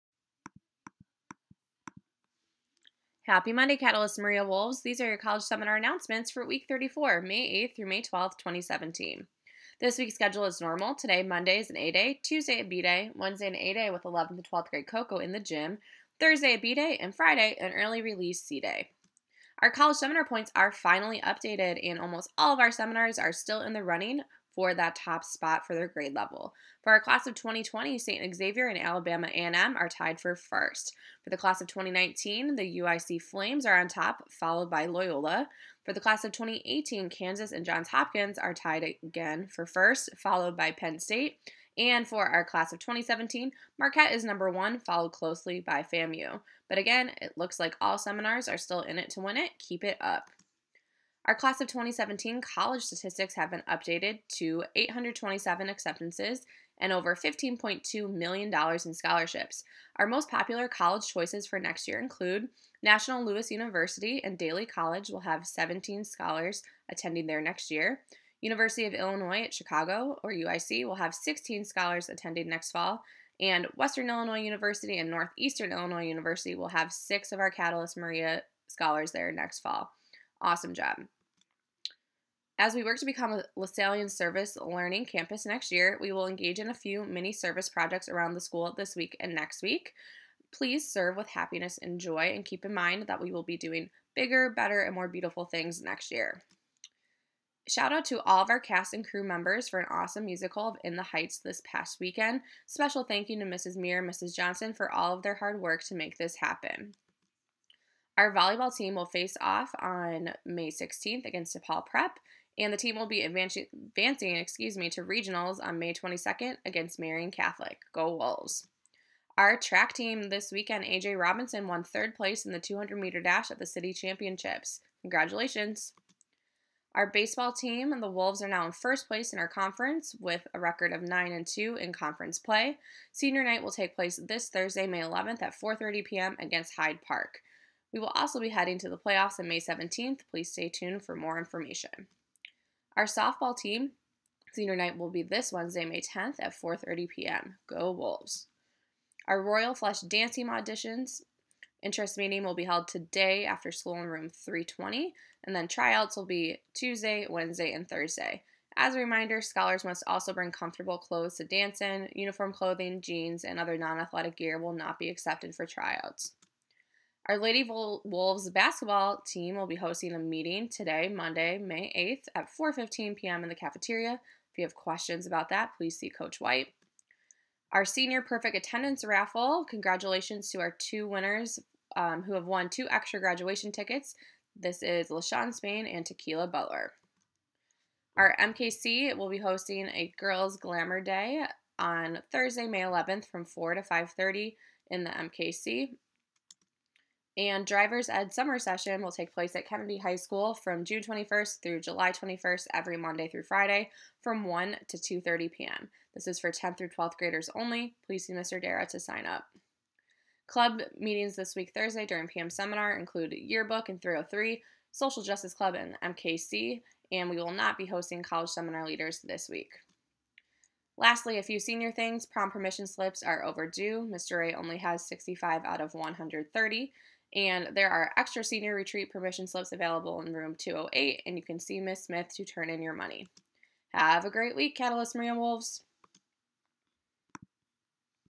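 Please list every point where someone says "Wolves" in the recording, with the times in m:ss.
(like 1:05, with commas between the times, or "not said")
0:04, 1:58, 2:08, 2:27, 2:47, 3:55.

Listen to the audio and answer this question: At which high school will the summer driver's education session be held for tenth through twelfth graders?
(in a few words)
Kennedy High School.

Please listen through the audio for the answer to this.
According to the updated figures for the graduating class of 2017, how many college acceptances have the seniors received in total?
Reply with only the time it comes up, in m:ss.
0:54.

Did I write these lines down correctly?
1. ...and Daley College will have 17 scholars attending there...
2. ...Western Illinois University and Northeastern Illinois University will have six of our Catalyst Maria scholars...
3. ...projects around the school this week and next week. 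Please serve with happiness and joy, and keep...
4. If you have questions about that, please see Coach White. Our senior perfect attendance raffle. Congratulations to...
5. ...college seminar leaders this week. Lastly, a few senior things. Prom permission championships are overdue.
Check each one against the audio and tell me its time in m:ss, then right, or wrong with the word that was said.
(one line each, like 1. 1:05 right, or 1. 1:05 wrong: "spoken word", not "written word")
1. 1:04 right
2. 1:13 right
3. 1:27 right
4. 2:54 right
5. 3:38 wrong: "slips", not "championships".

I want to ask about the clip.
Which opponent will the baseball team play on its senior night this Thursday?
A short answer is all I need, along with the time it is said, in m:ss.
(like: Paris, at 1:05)
Hyde Park, at 2:16.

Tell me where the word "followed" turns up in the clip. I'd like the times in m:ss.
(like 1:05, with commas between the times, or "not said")
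0:34, 0:40, 0:44.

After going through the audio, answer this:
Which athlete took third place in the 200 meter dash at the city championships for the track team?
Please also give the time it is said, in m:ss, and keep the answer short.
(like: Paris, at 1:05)
AJ Robinson, at 2:00.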